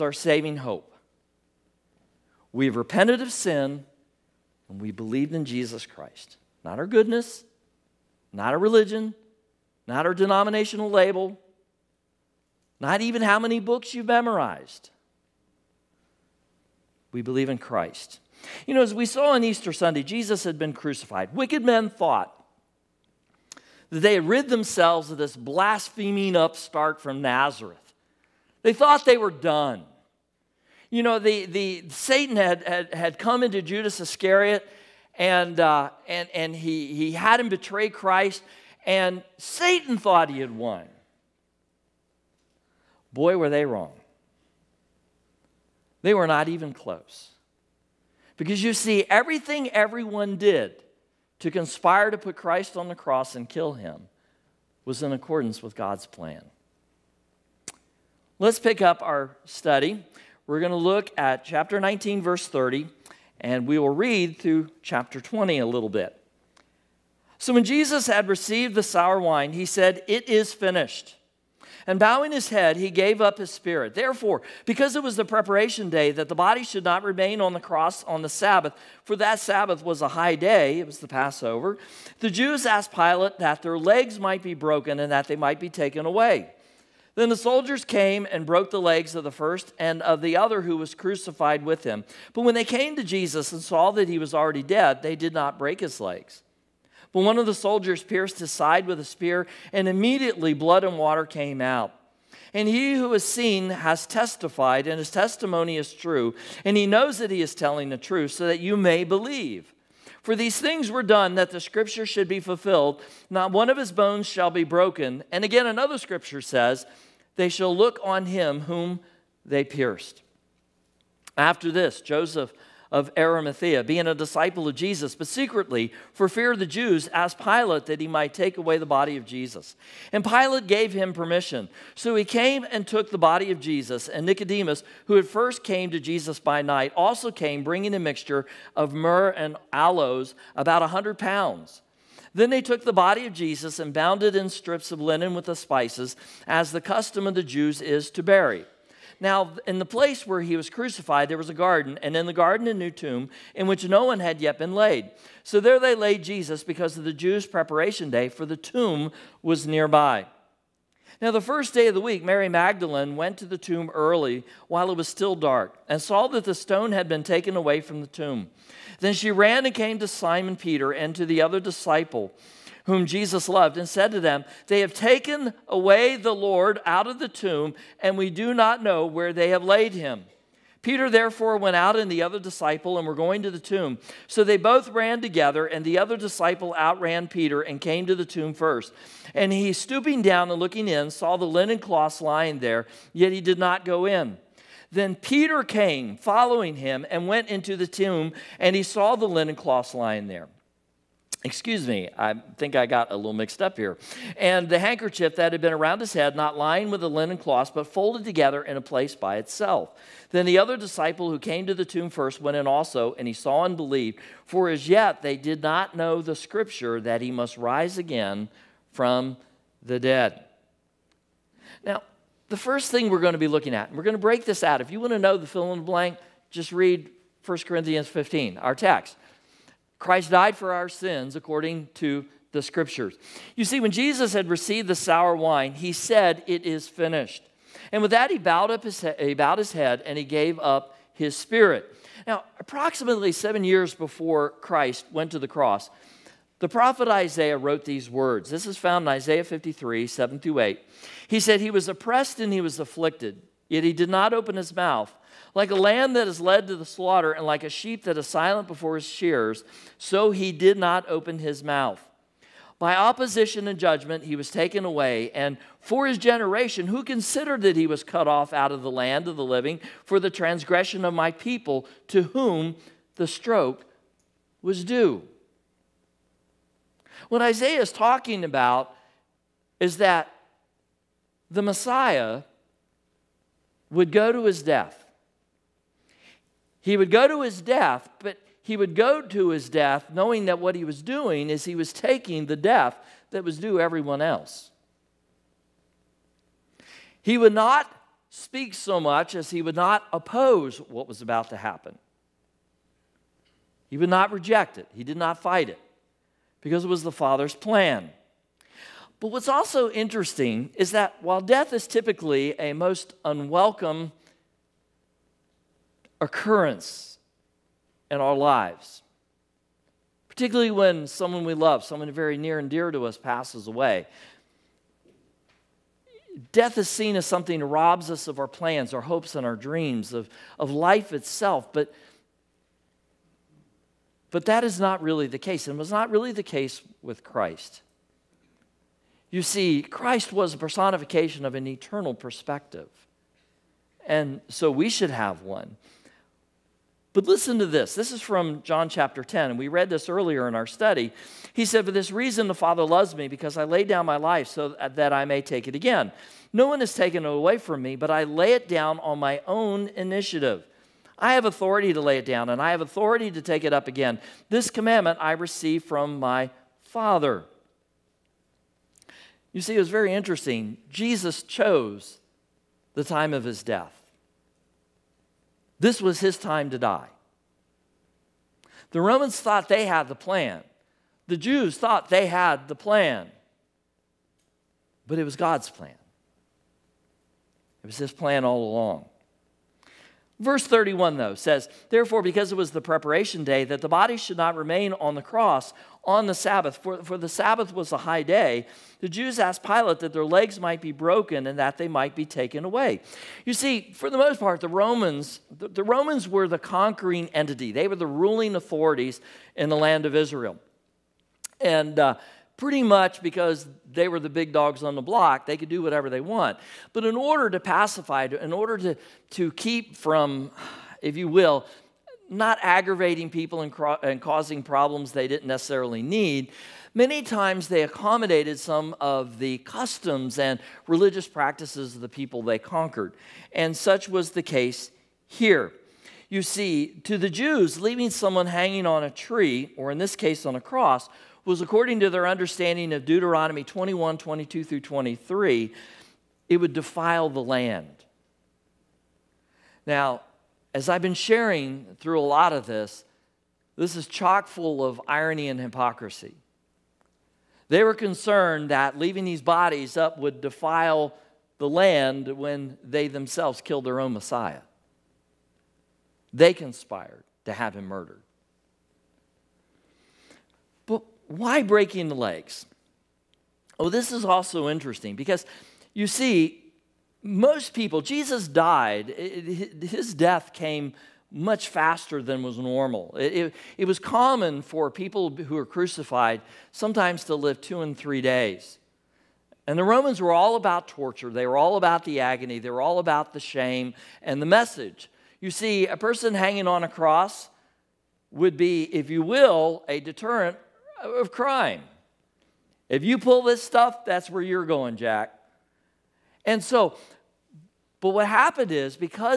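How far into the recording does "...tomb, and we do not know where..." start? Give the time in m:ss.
2:57.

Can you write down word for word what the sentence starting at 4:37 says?
What Isaiah is talking about is that the Messiah would go to his death.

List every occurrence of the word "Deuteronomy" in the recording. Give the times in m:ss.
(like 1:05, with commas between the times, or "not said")
7:23.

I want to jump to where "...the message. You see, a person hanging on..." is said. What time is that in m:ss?
8:14.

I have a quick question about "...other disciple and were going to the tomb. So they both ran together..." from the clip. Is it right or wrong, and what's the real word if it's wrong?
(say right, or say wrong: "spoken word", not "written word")
right.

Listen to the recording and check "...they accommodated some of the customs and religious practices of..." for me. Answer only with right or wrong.
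right.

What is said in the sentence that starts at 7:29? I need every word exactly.
Now, as I've been sharing through a lot of this, this is chock full of irony and hypocrisy.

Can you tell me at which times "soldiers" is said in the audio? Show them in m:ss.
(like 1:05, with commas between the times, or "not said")
1:27, 1:37.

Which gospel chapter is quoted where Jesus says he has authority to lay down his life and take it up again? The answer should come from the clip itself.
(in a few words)
John chapter 10.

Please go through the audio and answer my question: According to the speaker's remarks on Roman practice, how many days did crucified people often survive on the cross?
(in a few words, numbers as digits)
2 to 3 days.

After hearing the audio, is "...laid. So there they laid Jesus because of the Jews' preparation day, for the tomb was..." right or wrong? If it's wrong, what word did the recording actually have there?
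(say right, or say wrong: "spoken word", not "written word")
right.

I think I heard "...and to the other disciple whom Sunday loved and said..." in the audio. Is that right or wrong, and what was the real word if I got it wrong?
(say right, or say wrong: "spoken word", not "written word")
wrong: "Jesus", not "Sunday".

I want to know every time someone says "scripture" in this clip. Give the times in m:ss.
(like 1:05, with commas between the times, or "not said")
1:51, 1:55, 3:36, 3:52.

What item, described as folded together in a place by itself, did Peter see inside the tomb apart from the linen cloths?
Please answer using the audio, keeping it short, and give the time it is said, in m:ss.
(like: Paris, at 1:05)
The handkerchief, at 3:24.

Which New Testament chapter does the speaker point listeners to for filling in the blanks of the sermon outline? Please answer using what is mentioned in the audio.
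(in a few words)
1 Corinthians 15.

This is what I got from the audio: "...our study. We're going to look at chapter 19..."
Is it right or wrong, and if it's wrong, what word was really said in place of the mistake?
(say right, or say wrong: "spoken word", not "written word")
right.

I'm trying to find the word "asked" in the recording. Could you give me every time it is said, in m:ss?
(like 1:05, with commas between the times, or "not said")
1:22, 2:07, 6:39.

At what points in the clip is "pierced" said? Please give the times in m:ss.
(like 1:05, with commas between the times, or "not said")
1:38, 1:59.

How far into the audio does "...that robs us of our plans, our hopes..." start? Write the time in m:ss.
5:27.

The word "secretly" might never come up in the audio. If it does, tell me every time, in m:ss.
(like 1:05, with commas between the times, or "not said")
2:05.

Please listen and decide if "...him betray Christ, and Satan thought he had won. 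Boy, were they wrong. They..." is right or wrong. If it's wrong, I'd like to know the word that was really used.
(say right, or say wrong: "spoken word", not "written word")
right.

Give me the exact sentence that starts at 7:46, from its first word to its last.
They conspired to have him murdered why breaking the legs?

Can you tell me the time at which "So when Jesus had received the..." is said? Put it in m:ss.
1:07.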